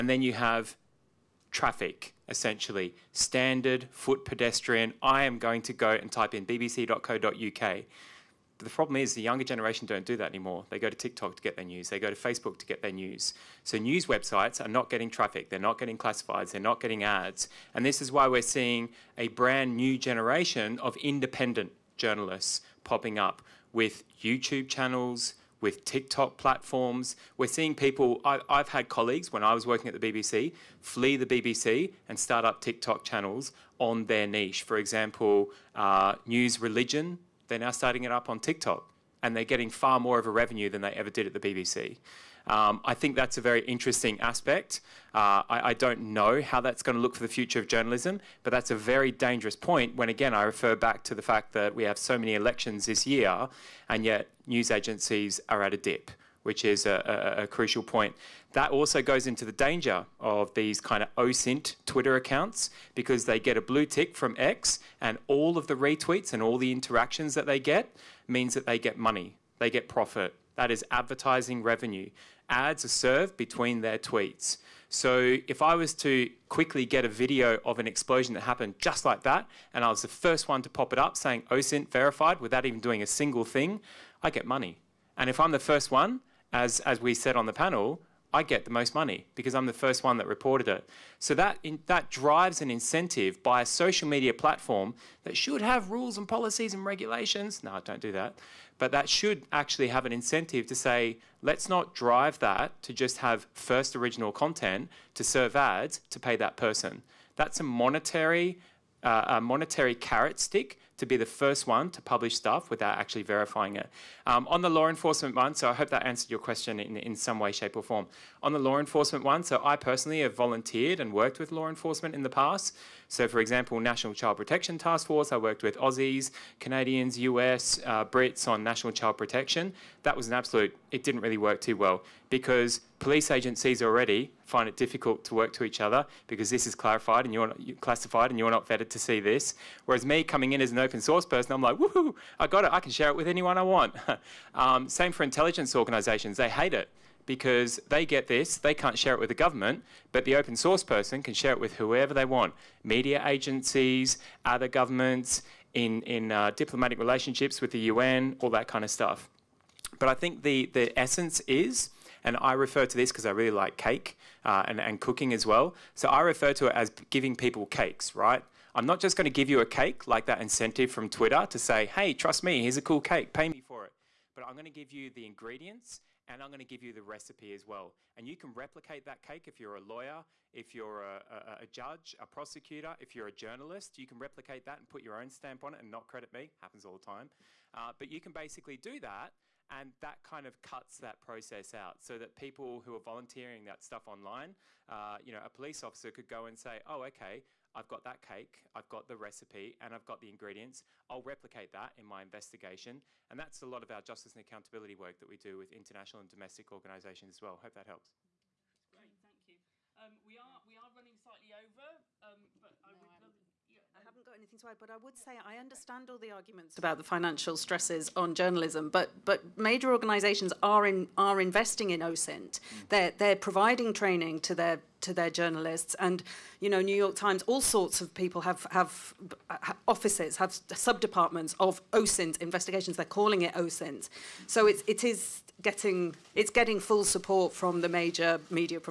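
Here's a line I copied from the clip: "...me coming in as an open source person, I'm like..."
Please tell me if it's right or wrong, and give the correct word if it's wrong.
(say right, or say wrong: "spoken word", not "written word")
right.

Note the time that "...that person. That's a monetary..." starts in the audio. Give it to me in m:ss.
1:46.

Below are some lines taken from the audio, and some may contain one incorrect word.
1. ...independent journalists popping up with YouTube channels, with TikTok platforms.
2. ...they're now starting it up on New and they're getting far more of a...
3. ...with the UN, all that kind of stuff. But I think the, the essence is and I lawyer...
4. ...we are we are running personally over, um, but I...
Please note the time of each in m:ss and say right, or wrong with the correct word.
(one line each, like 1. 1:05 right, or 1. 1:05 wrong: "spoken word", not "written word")
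1. 0:20 right
2. 0:37 wrong: "TikTok", not "New"
3. 2:37 wrong: "refer", not "lawyer"
4. 3:30 wrong: "slightly", not "personally".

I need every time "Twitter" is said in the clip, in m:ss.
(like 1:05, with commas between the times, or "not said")
1:01, 2:51.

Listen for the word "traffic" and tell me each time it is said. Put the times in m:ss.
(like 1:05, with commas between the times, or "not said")
0:01, 0:15.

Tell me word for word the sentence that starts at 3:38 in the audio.
But but major organisations are in are investing in OSINT.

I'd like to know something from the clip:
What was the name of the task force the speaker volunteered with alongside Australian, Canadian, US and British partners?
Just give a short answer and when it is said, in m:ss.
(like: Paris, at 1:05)
National Child Protection Task Force, at 2:03.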